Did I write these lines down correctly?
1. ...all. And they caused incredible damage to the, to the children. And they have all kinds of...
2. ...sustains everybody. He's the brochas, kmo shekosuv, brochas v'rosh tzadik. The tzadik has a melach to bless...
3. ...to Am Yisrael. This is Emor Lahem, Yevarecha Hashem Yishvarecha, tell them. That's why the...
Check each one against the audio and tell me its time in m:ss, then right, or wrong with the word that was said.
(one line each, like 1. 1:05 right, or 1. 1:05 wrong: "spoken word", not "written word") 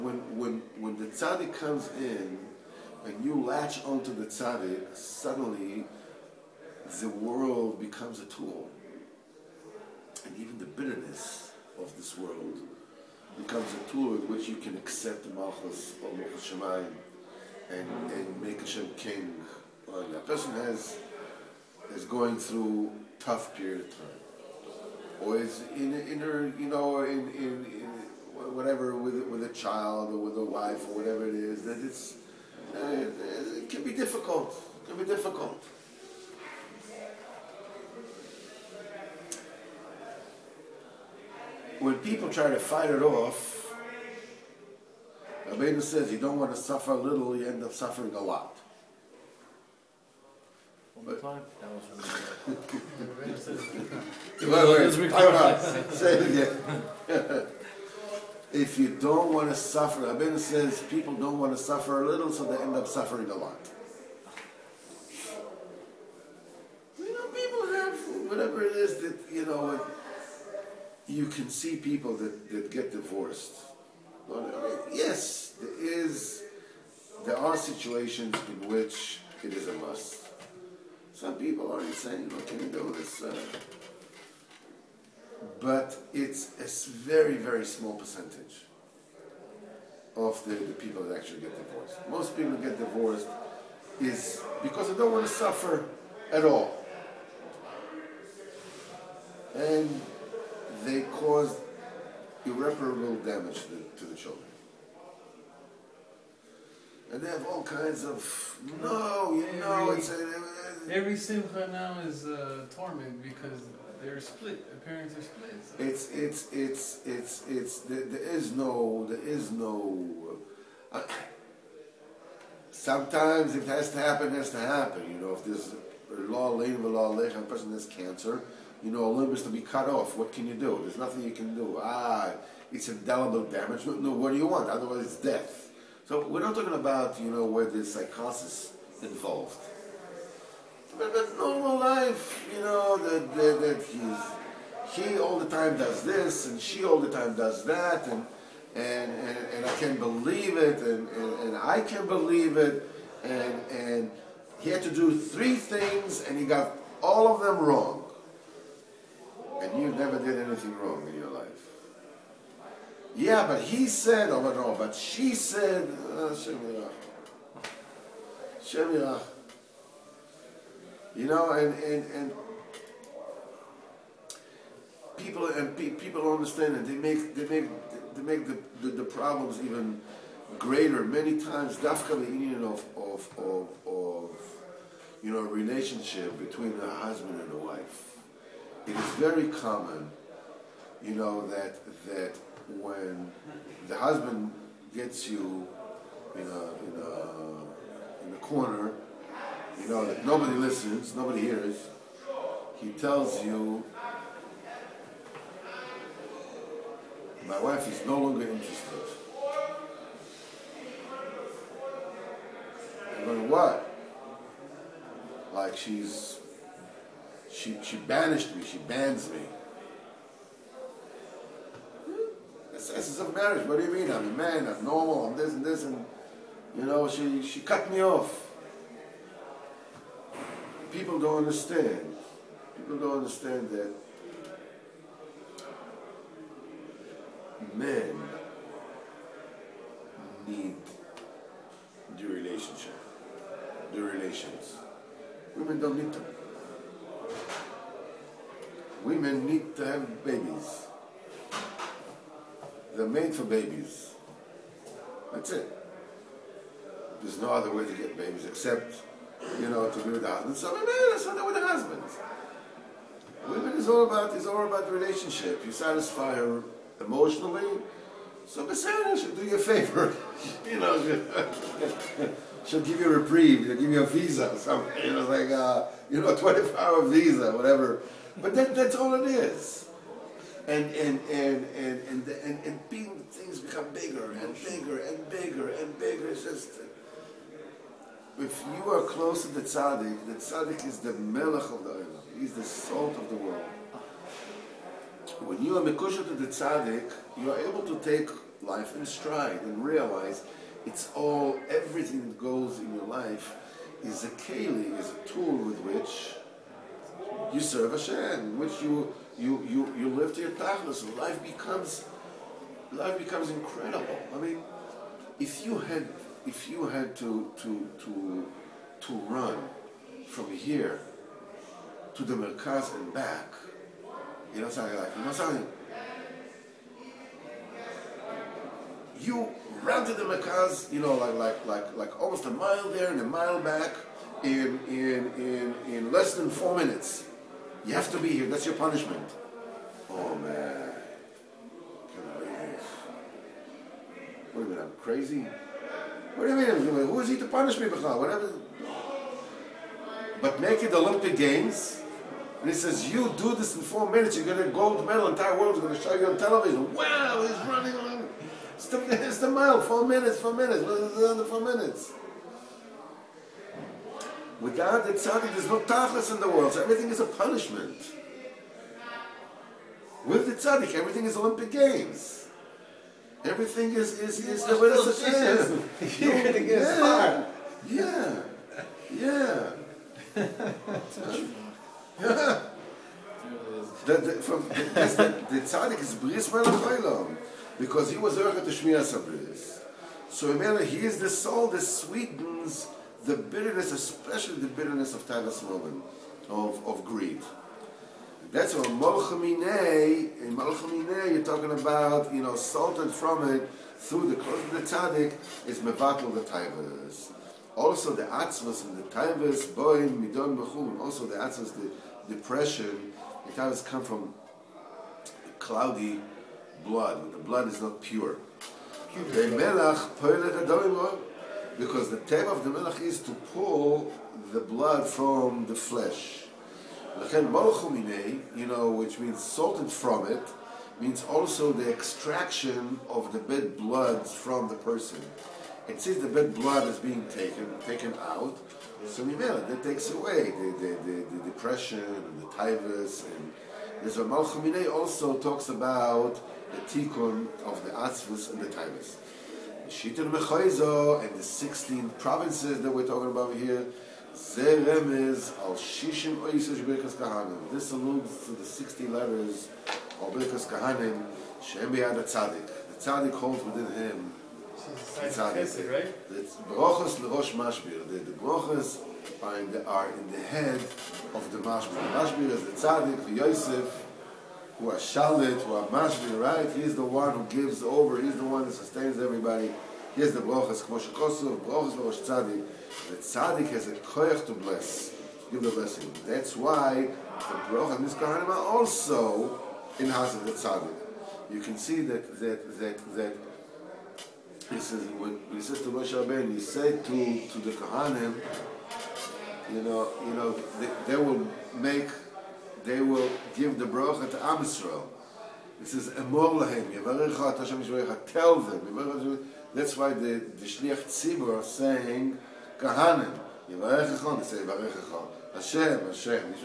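1. 1:36 wrong: "irreparable", not "incredible"
2. 7:58 wrong: "koyach", not "melach"
3. 8:24 right.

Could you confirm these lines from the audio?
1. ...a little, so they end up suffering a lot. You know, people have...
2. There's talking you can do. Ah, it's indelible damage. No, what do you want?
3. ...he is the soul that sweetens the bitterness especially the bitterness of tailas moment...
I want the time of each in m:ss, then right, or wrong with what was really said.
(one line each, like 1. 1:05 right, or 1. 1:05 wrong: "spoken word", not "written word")
1. 1:02 right
2. 2:10 wrong: "nothing", not "talking"
3. 6:30 right.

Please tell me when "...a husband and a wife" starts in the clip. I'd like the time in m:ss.
3:06.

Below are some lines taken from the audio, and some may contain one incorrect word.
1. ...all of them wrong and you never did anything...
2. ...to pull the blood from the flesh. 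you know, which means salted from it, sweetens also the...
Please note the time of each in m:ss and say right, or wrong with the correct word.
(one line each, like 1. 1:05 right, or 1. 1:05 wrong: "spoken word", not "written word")
1. 2:37 right
2. 7:03 wrong: "means", not "sweetens".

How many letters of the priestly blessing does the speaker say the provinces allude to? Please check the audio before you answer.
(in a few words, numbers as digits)
16.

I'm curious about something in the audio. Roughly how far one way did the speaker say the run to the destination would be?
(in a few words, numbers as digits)
almost a mile.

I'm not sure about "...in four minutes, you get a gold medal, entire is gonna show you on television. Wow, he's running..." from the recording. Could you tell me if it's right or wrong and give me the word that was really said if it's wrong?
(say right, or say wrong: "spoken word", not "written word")
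right.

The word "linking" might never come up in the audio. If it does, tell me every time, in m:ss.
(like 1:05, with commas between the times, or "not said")
not said.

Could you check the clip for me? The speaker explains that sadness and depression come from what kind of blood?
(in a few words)
cloudy blood.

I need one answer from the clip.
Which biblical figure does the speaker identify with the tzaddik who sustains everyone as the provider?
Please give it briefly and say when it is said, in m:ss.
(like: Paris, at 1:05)
Yosef, at 7:53.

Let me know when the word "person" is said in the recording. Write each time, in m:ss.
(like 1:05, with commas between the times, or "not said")
0:20, 2:07, 7:14.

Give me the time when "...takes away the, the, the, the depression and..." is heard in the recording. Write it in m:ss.
7:19.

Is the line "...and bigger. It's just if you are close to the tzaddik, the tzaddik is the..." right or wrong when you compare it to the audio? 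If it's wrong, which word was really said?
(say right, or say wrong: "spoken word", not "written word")
right.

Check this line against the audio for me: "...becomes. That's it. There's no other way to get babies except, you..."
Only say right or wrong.
wrong.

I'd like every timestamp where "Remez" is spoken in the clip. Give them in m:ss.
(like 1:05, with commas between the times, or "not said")
7:34.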